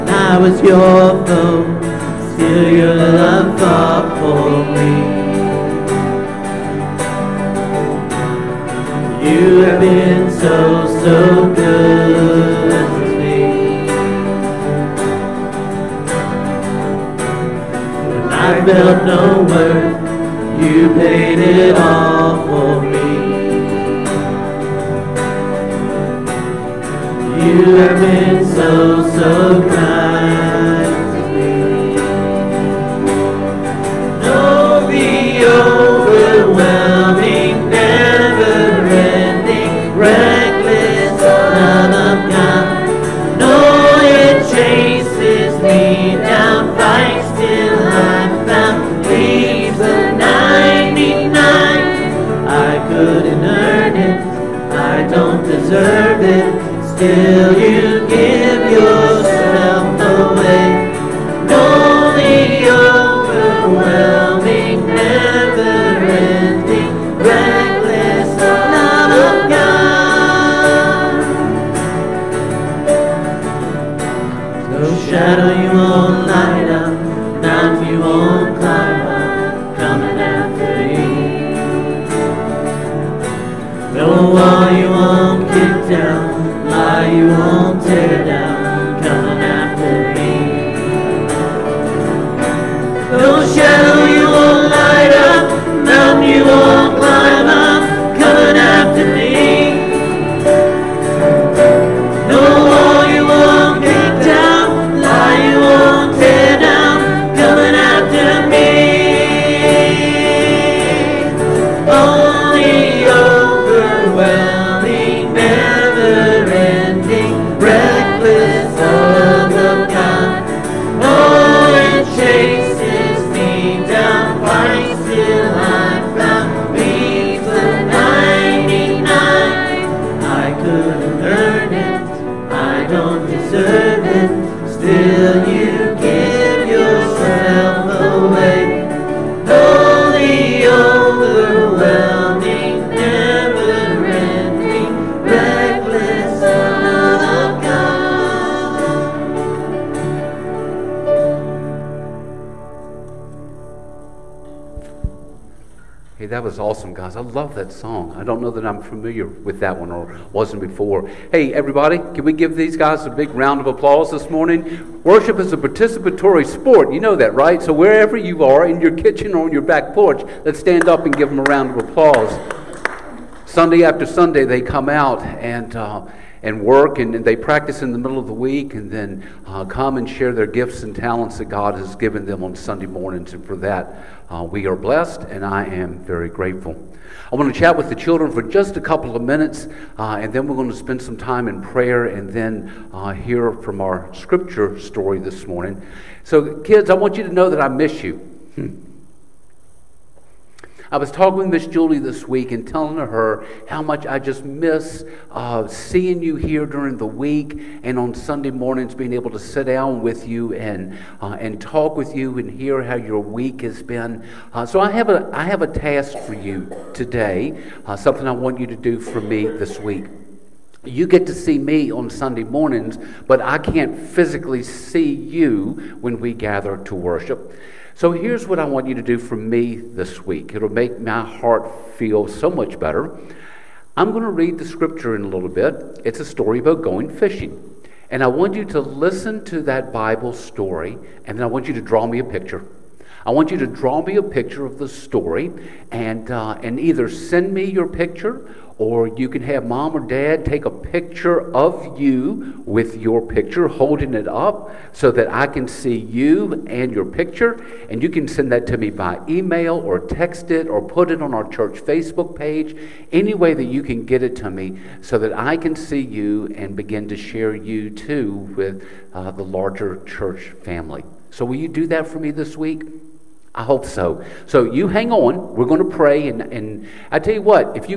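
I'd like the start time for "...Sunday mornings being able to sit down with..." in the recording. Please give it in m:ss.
3:28.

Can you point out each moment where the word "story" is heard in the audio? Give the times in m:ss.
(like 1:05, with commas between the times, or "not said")
3:14, 3:56, 4:00, 4:04.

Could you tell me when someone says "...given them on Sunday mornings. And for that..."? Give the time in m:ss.
3:01.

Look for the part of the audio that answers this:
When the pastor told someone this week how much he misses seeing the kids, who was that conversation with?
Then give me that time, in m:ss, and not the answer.
3:21.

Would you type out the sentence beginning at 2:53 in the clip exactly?
Sunday after Sunday, they come out and.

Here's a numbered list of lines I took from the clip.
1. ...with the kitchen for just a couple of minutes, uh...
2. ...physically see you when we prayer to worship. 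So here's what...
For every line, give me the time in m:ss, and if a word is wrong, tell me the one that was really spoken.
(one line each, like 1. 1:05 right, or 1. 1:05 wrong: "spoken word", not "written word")
1. 3:07 wrong: "children", not "kitchen"
2. 3:44 wrong: "gather", not "prayer".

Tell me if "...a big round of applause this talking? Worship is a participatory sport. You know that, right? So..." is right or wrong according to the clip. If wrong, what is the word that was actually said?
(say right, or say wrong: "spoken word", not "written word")
wrong: "morning", not "talking".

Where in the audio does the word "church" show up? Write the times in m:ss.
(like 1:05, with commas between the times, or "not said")
4:21, 4:30.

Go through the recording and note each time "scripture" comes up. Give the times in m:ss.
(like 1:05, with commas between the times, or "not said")
3:14, 3:54.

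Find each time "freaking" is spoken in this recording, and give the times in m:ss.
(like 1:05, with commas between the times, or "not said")
not said.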